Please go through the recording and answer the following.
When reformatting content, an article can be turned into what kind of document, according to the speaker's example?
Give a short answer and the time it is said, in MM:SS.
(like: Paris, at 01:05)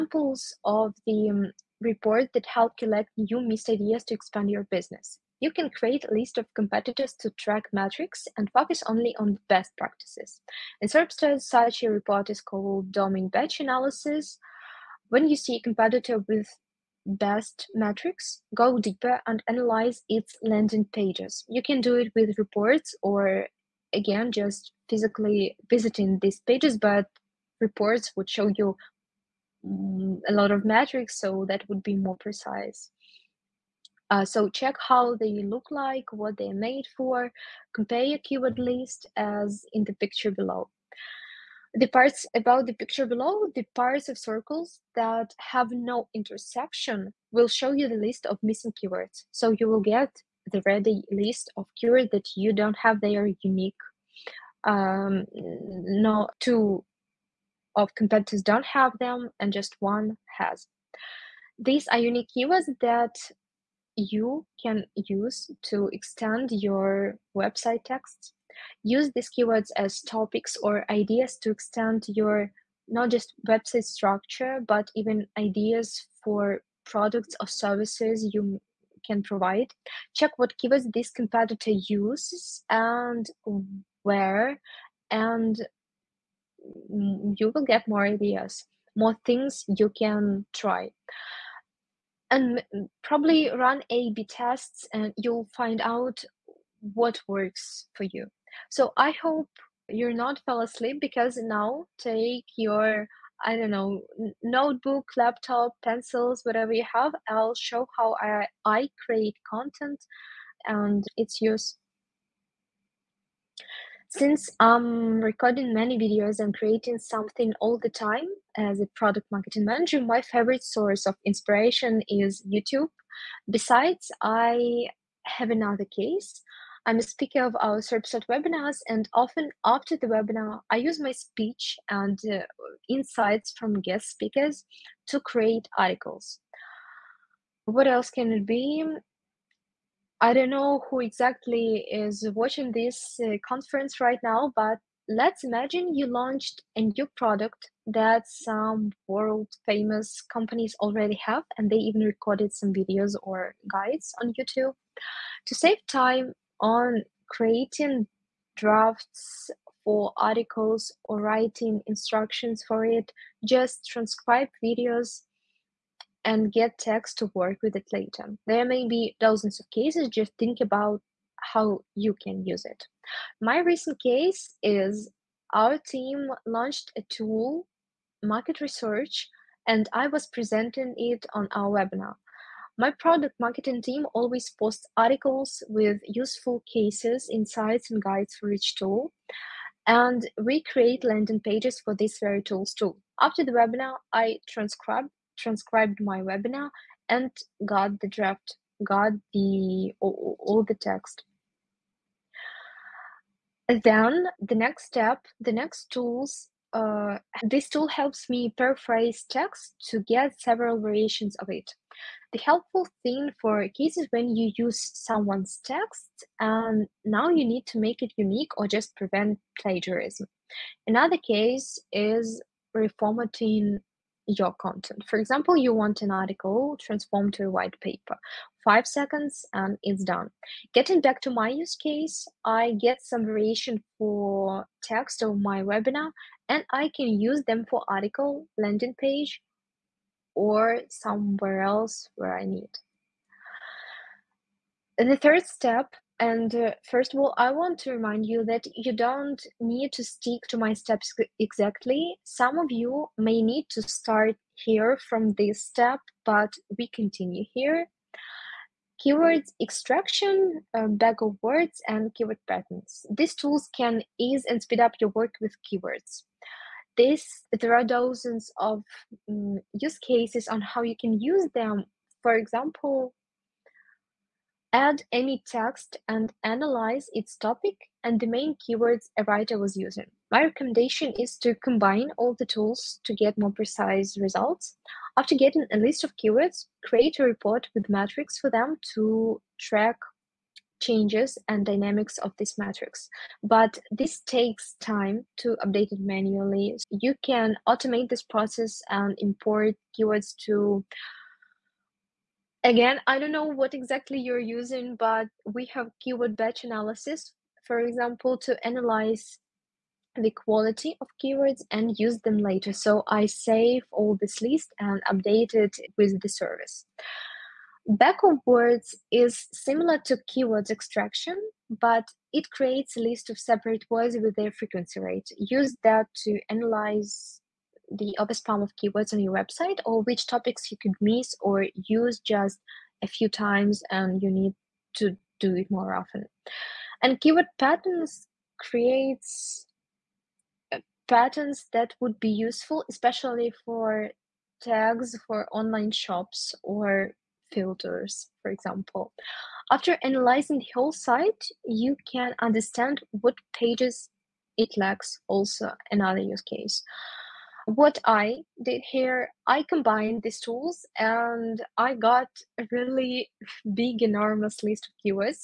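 white paper, at 03:47.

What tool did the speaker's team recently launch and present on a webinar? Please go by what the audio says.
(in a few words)
market research.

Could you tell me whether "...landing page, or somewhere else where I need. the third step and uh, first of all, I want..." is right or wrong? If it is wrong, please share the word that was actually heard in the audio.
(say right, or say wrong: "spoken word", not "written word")
right.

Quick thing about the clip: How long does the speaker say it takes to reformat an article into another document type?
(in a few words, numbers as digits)
5 seconds.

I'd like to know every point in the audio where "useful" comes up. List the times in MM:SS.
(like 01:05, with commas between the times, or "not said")
03:06, 05:42.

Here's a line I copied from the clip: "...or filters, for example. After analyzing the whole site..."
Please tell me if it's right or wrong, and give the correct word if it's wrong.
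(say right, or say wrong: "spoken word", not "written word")
right.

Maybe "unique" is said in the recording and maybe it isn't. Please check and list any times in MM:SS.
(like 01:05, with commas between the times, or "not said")
00:53, 01:01, 03:38.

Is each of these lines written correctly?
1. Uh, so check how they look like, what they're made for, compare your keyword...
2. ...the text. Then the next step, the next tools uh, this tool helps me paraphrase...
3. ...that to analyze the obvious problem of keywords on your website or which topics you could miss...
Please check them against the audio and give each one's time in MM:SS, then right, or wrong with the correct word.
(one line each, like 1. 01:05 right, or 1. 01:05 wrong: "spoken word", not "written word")
1. 00:34 right
2. 03:20 right
3. 05:25 right.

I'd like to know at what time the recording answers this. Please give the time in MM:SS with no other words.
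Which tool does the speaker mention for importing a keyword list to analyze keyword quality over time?
05:05.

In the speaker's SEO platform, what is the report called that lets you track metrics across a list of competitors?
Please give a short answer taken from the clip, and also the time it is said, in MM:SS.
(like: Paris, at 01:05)
domain batch analysis, at 00:12.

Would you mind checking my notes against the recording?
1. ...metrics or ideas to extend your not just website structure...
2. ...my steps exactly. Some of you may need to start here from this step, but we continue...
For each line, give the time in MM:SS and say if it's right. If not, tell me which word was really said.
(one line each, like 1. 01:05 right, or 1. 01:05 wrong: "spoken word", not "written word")
1. 01:10 wrong: "topics", not "metrics"
2. 04:10 right.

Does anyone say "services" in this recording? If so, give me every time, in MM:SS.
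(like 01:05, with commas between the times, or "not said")
01:17, 05:16.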